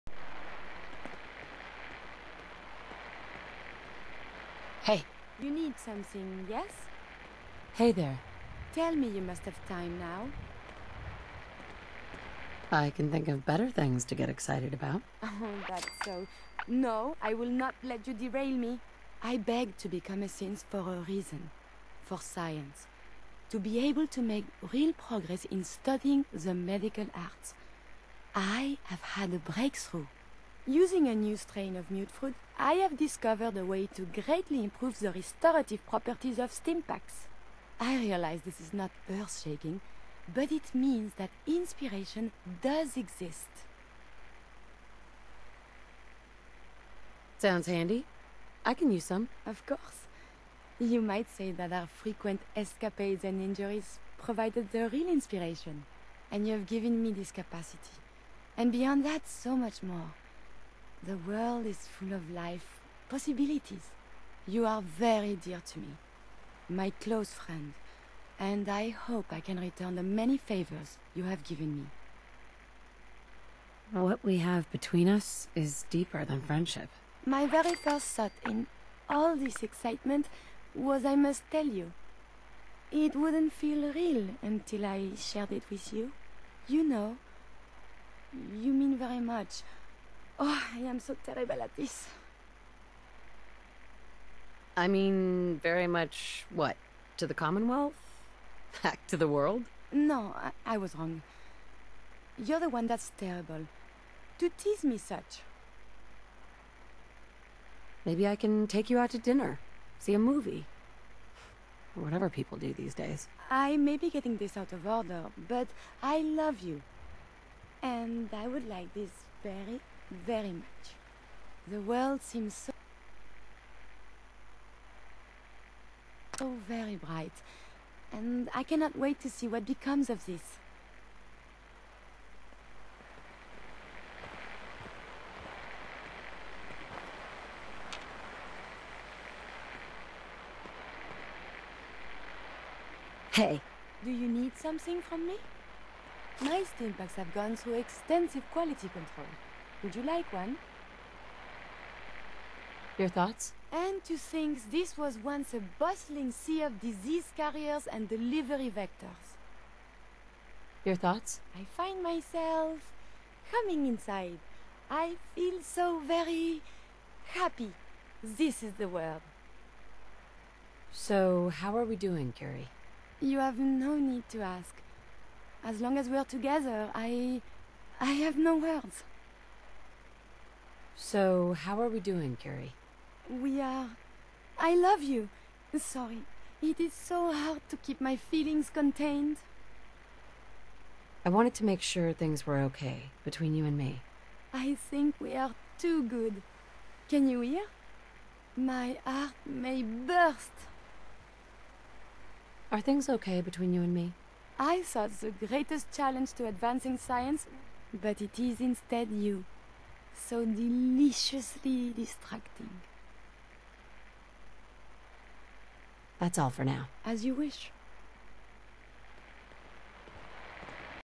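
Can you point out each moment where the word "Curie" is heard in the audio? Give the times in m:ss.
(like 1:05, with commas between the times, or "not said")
2:52, 3:02.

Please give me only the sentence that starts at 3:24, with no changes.
I thought the greatest challenge to advancing science, but it is instead you so deliciously distracting.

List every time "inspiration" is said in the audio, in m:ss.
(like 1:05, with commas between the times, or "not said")
0:41, 0:55.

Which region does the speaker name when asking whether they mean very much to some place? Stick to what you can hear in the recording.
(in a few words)
the Commonwealth.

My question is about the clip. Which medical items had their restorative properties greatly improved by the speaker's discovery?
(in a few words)
stimpaks.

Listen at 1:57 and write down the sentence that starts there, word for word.
And I would like this very very much.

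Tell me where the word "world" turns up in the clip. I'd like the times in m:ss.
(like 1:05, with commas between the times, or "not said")
1:01, 1:39, 2:01, 2:48.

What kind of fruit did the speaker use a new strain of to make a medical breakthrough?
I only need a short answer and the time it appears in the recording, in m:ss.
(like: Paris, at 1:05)
mutfruit, at 0:31.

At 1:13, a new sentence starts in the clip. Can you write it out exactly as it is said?
What we have between us is deeper than friendship.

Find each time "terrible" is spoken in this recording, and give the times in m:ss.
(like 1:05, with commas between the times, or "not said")
1:31, 1:43.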